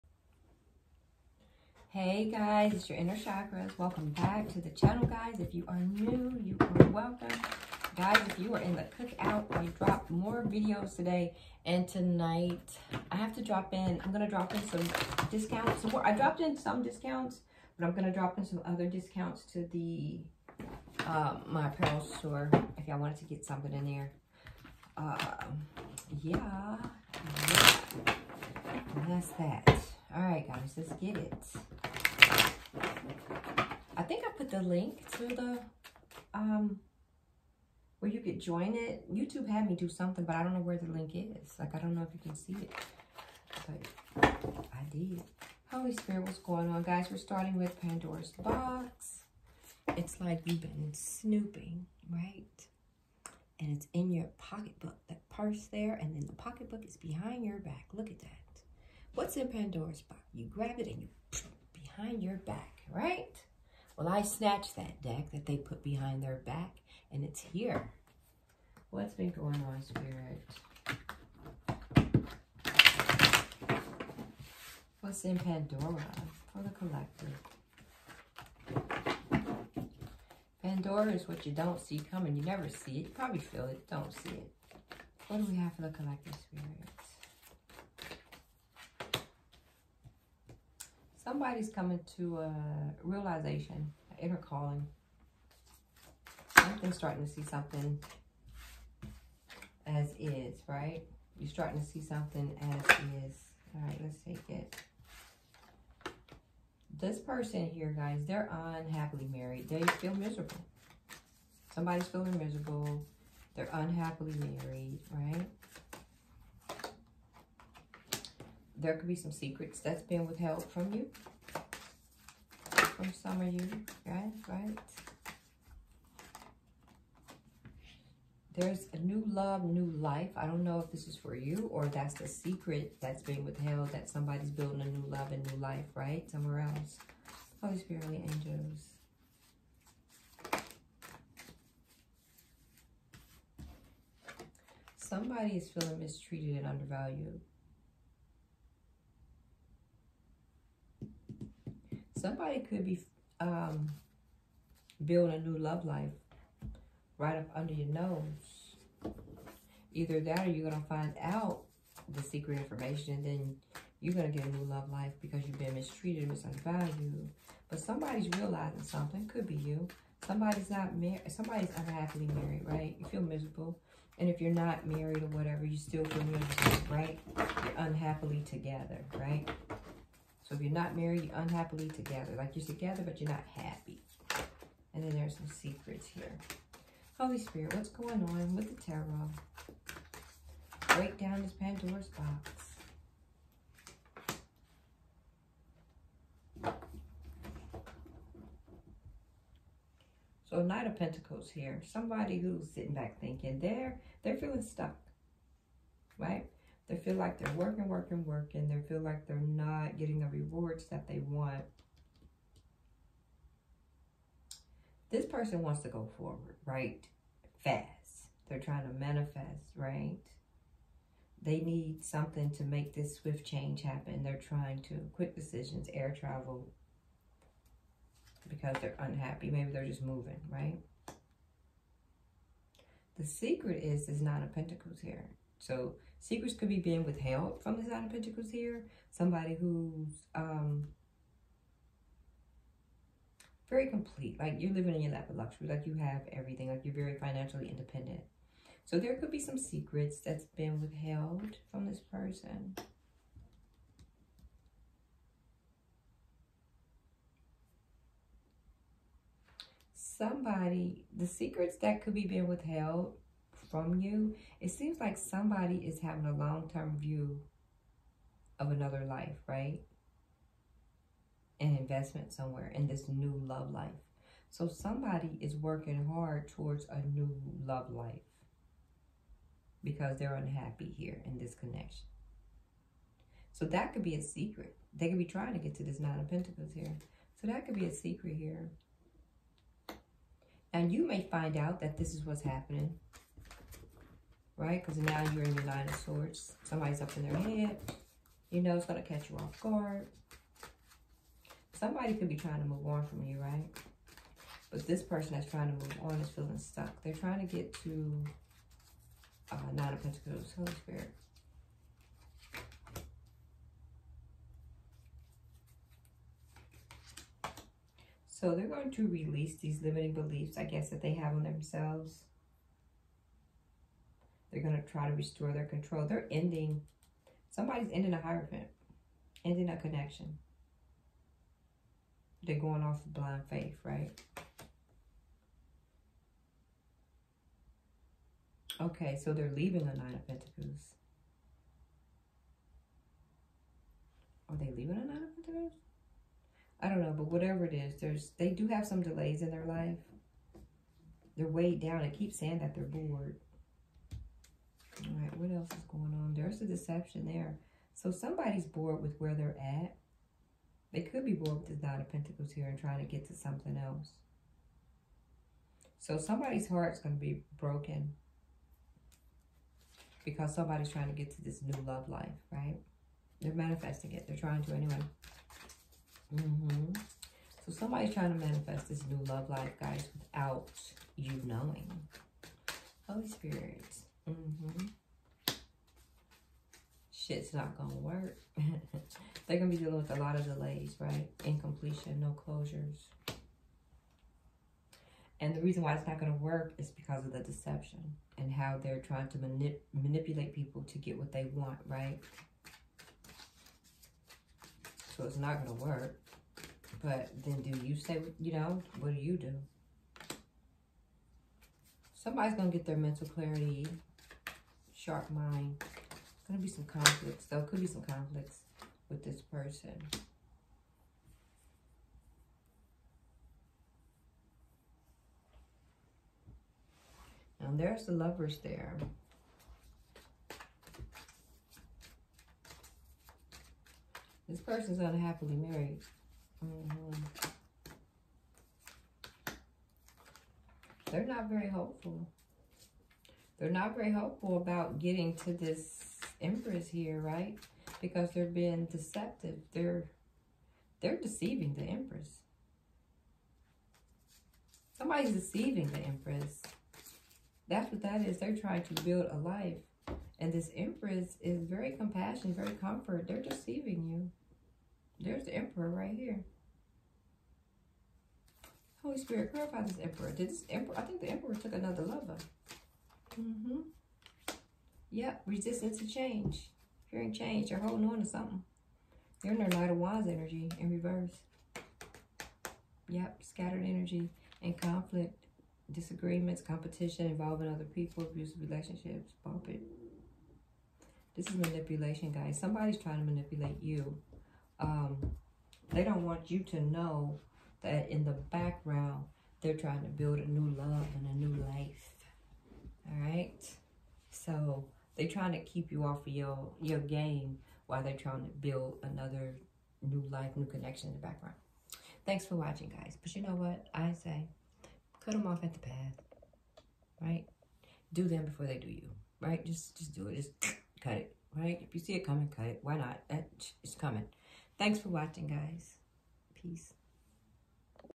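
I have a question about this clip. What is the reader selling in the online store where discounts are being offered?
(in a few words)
Apparel.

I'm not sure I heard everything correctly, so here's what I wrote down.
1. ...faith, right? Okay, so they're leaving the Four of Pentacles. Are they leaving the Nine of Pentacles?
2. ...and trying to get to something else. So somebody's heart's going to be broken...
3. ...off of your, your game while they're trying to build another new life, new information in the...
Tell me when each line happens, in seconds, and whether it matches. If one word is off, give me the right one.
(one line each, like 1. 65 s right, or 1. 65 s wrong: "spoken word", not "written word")
1. 333 s wrong: "Nine", not "Four"
2. 362 s right
3. 506 s wrong: "connection", not "information".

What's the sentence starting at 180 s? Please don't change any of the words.
So if you're not married, you're unhappily together.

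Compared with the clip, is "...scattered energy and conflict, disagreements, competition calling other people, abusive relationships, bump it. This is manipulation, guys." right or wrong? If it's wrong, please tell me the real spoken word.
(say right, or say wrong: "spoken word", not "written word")
wrong: "involving", not "calling".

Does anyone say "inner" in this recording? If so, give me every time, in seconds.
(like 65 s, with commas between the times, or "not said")
2 s, 94 s.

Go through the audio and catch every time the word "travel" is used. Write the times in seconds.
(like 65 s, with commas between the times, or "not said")
226 s.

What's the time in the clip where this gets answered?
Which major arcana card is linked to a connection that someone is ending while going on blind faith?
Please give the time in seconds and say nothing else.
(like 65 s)
328 s.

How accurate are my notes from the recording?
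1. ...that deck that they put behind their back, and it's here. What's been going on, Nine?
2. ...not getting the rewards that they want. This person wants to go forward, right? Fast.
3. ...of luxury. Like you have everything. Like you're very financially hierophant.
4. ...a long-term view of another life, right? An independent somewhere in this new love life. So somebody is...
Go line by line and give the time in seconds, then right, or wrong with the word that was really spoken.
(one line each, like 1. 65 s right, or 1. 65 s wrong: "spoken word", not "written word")
1. 64 s wrong: "Spirit", not "Nine"
2. 209 s right
3. 245 s wrong: "independent", not "hierophant"
4. 266 s wrong: "investment", not "independent".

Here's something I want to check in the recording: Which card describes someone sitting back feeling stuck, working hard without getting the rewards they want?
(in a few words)
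Knight of Pentacles.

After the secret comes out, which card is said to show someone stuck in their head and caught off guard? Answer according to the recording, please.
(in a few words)
Nine of Swords.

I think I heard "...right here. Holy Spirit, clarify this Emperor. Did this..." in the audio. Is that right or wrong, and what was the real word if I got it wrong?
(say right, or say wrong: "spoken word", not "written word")
right.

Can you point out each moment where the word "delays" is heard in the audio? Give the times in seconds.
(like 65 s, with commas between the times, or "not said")
349 s, 390 s.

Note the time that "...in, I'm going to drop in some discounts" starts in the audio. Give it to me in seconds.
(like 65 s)
13 s.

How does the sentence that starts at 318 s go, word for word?
So they're going to release these limiting beliefs, I guess, that they have on themselves.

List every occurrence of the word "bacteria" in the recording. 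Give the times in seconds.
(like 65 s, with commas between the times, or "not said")
not said.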